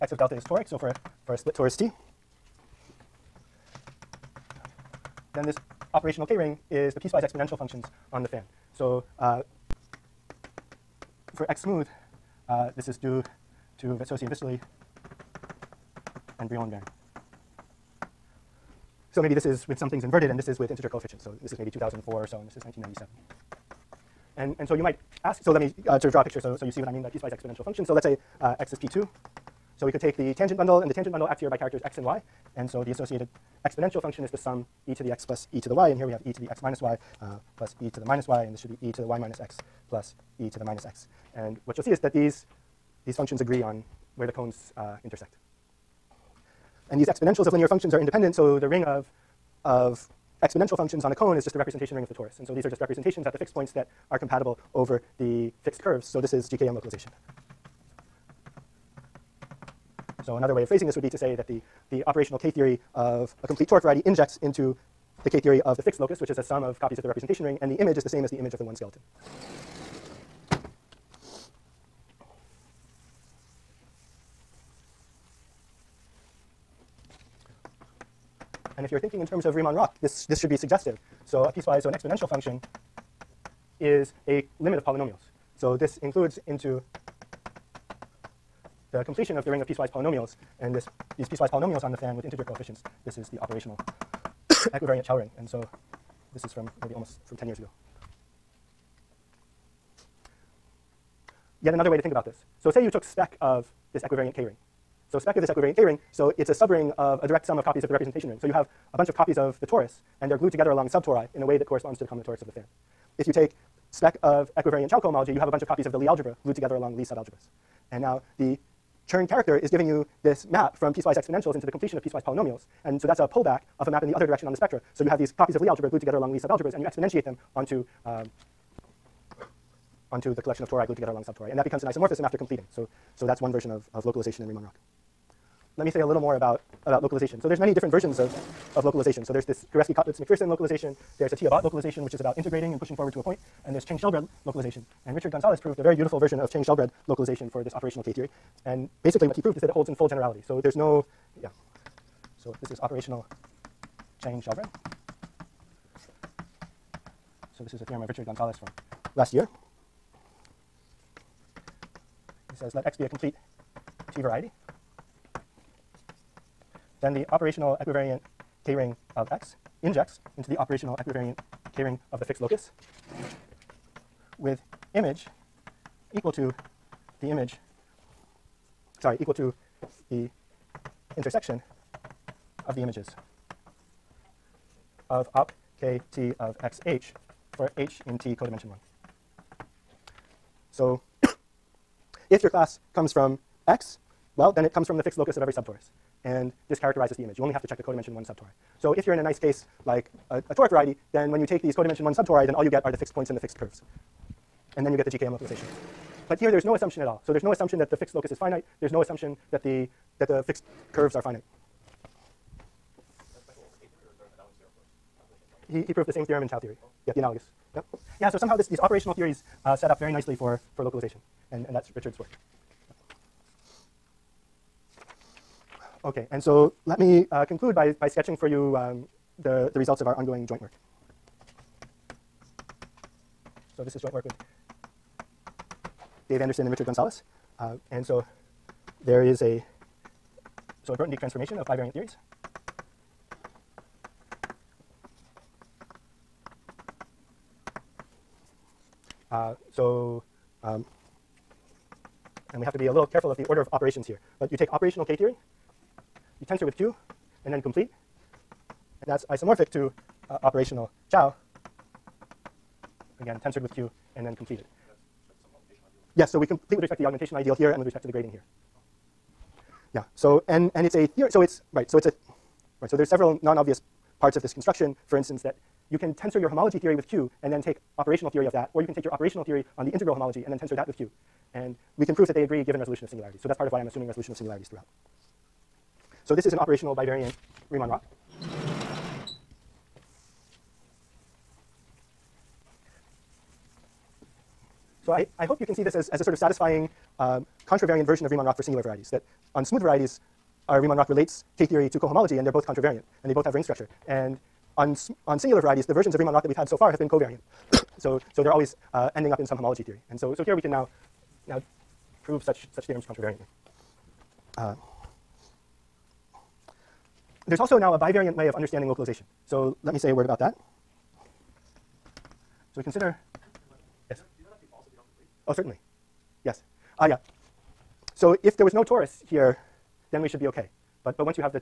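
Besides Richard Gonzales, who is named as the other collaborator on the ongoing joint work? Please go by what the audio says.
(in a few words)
Dave Anderson.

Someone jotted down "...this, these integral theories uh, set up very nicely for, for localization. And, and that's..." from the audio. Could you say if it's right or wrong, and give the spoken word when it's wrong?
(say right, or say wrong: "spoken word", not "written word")
wrong: "operational", not "integral".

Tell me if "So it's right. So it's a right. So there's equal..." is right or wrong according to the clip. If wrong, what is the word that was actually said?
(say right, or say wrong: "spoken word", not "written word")
wrong: "several", not "equal".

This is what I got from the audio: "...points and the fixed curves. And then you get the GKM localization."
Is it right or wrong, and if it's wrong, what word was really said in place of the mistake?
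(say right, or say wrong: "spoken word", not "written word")
right.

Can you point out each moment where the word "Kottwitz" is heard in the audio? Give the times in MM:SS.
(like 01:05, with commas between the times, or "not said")
02:19.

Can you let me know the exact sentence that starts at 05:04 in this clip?
And on, on singular varieties, the versions of Riemann-Roch that we've had so far have been covariant.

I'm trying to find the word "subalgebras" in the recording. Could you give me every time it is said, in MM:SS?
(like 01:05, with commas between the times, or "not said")
01:57, 02:06.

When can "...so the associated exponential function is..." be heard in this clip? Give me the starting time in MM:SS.
00:32.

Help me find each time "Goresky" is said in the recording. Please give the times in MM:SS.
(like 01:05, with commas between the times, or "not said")
02:19.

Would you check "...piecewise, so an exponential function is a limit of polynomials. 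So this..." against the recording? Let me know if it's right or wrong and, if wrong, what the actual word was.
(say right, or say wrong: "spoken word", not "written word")
right.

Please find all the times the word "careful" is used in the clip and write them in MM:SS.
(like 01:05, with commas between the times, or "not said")
04:13.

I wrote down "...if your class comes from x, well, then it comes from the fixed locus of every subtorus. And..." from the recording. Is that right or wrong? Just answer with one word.
right.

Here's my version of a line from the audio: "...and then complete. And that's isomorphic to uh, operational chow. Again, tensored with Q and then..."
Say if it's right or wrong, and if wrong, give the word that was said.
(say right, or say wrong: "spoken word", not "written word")
right.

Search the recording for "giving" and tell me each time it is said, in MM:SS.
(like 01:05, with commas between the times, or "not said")
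01:59.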